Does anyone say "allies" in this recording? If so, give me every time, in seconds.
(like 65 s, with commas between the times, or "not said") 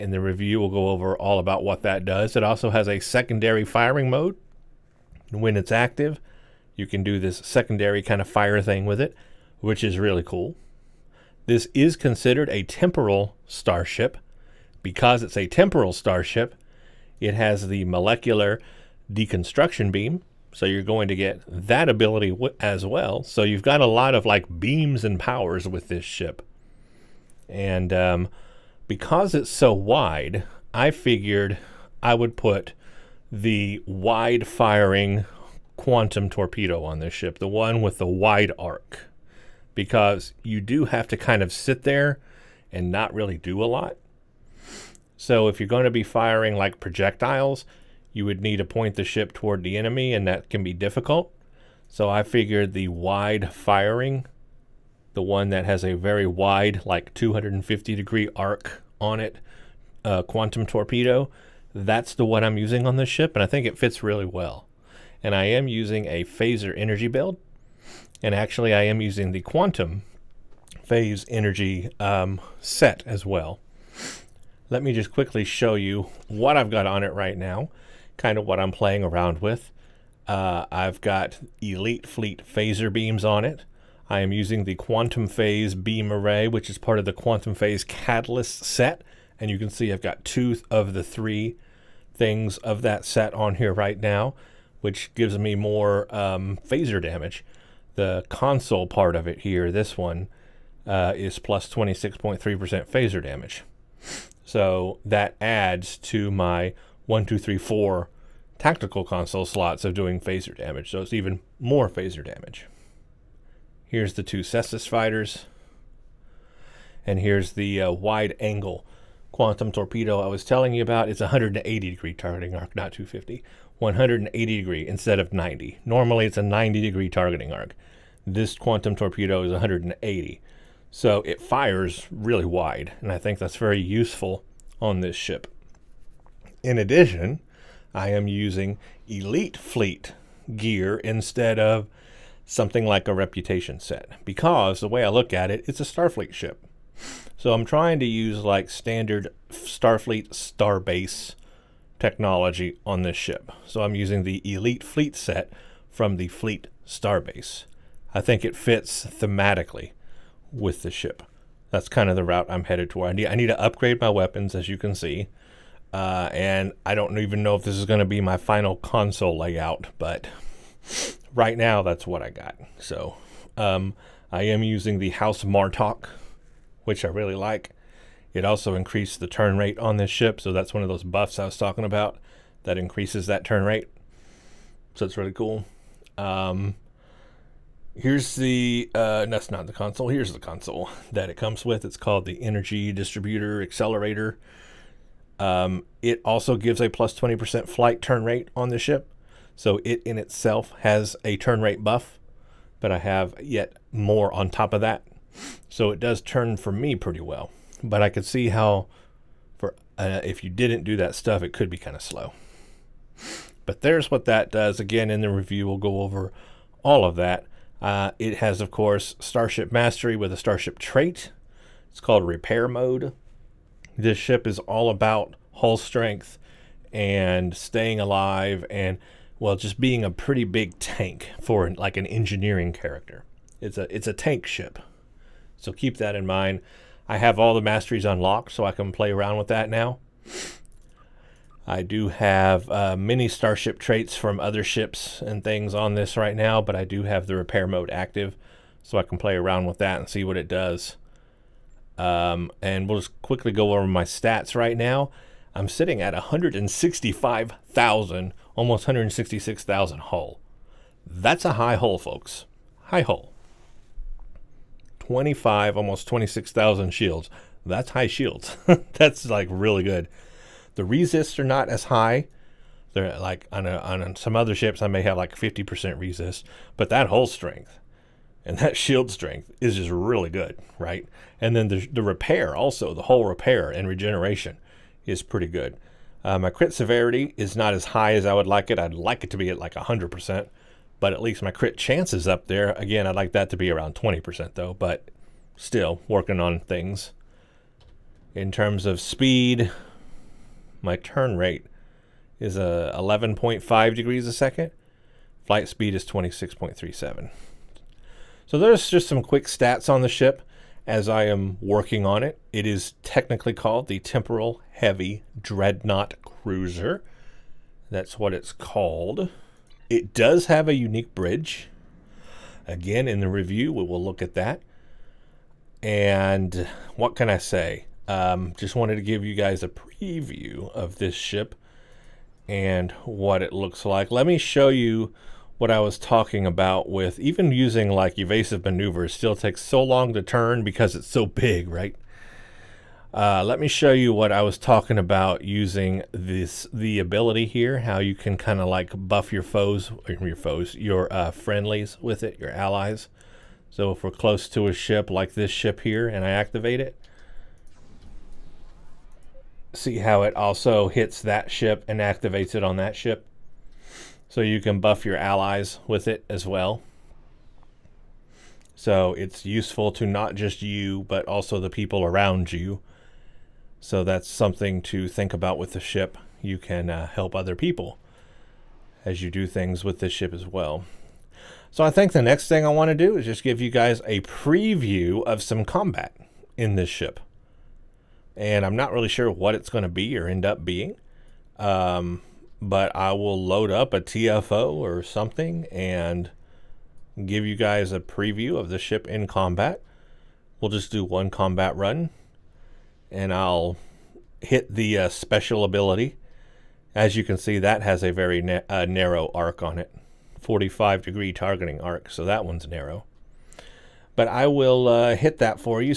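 352 s, 365 s.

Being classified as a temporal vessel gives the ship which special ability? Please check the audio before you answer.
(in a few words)
Molecular deconstruction beam.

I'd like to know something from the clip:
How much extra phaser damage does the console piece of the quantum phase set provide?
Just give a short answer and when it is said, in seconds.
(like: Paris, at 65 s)
26.3%, at 101 s.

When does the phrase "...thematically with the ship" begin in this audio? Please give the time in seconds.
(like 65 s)
159 s.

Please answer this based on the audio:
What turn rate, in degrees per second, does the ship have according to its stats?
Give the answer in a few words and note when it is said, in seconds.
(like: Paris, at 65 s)
11.5, at 303 s.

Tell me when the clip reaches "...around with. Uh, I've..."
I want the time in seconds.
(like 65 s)
79 s.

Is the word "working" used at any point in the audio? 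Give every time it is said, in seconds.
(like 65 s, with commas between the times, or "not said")
296 s, 311 s.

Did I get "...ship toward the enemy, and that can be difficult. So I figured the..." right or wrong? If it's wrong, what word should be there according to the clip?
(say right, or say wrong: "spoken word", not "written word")
right.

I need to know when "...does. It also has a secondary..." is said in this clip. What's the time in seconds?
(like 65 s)
2 s.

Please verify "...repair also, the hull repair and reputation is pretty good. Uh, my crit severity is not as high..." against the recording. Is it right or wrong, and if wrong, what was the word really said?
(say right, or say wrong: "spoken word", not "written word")
wrong: "regeneration", not "reputation".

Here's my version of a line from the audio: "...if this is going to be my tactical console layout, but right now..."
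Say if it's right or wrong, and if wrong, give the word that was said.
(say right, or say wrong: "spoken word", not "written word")
wrong: "final", not "tactical".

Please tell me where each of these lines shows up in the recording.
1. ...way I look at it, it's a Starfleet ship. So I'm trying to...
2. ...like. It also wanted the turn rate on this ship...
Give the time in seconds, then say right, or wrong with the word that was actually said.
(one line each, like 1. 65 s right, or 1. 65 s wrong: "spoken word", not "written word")
1. 144 s right
2. 177 s wrong: "increased", not "wanted".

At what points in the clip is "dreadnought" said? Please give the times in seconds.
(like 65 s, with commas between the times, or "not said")
315 s.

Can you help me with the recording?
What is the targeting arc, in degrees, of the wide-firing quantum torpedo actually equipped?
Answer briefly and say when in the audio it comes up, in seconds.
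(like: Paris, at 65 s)
180, at 121 s.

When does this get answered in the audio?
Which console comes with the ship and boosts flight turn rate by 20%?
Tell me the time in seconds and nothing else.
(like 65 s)
192 s.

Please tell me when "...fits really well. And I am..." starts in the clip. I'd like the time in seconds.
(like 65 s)
63 s.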